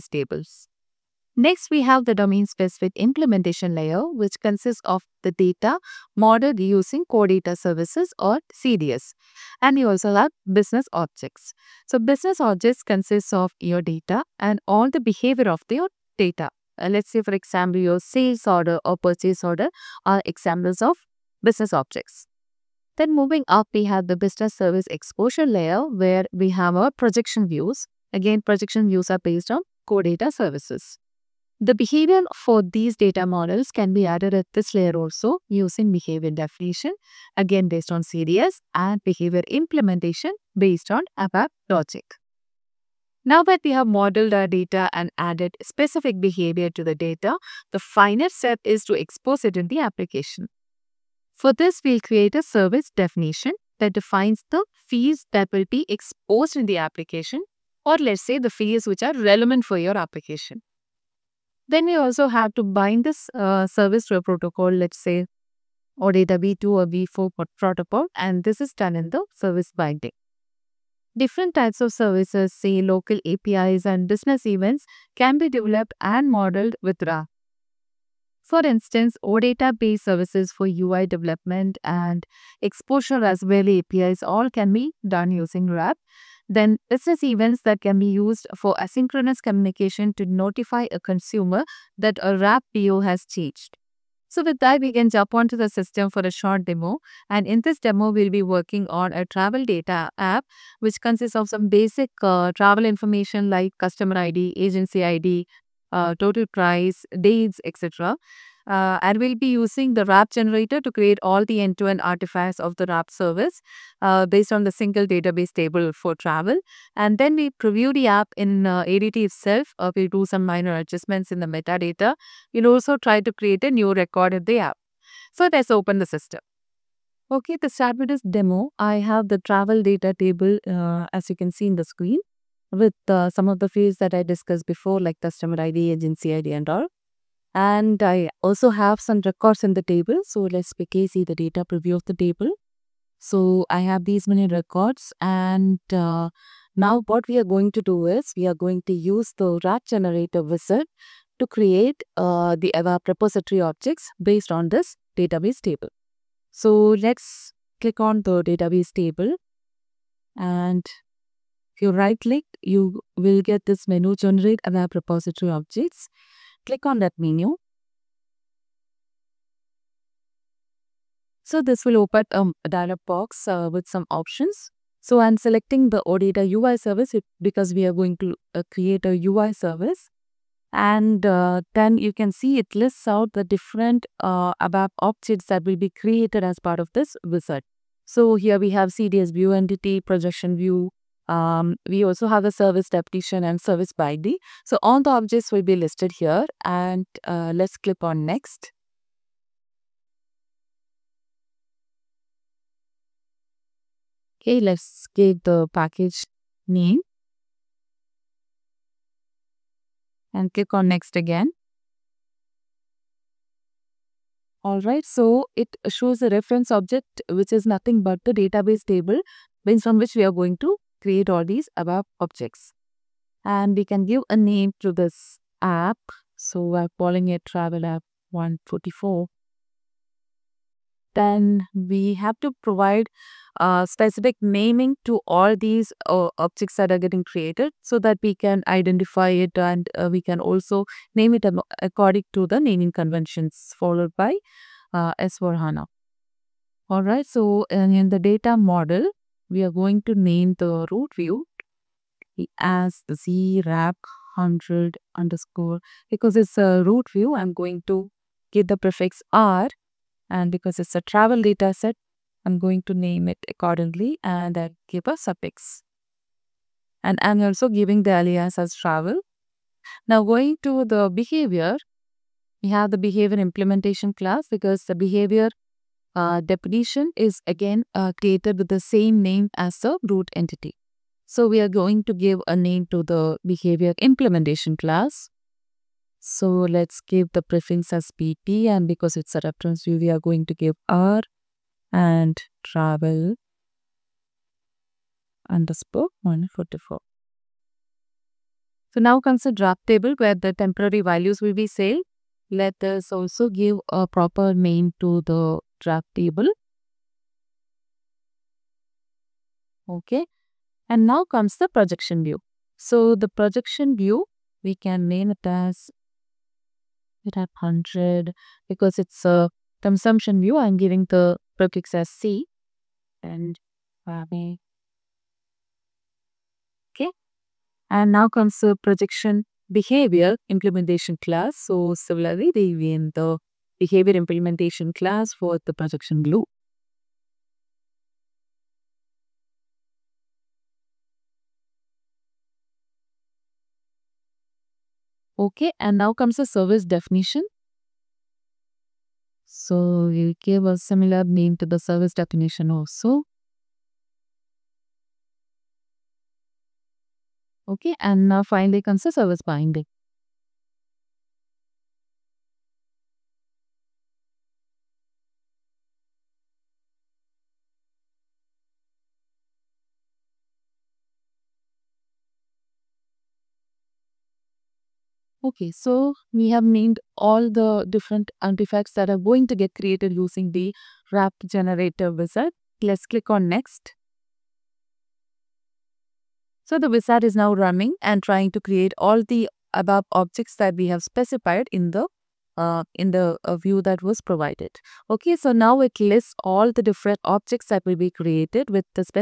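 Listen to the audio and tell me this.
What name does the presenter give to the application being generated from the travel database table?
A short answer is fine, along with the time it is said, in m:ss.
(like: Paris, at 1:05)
Travel App 144, at 3:47.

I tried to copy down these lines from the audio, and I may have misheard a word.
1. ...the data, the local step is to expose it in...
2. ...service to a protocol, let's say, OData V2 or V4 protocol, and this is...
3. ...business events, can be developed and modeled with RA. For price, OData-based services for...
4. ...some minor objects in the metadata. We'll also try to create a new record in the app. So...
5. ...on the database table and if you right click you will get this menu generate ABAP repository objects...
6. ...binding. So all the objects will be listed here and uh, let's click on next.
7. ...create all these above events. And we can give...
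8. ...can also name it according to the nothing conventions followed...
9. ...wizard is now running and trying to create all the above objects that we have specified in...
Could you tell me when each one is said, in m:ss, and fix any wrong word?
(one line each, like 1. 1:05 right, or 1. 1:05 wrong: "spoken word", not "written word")
1. 0:46 wrong: "final", not "local"
2. 1:03 right
3. 1:14 wrong: "instance", not "price"
4. 2:00 wrong: "adjustments", not "objects"
5. 2:37 right
6. 3:13 right
7. 3:41 wrong: "objects", not "events"
8. 4:00 wrong: "naming", not "nothing"
9. 6:26 right.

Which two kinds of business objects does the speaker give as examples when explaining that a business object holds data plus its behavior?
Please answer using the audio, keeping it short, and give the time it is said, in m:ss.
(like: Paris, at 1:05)
sales order or purchase order, at 0:18.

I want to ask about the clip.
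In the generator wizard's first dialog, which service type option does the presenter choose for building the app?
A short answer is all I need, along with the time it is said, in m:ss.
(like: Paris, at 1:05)
OData UI service, at 2:56.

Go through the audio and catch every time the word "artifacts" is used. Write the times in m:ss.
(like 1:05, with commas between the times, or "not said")
1:52, 6:18.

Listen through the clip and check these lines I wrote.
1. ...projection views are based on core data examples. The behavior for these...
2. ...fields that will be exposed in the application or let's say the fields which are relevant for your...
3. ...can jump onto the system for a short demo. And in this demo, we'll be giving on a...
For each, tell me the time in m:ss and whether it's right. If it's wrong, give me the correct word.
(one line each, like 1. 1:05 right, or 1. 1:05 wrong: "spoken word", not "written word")
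1. 0:28 wrong: "services", not "examples"
2. 0:54 right
3. 1:34 wrong: "working", not "giving".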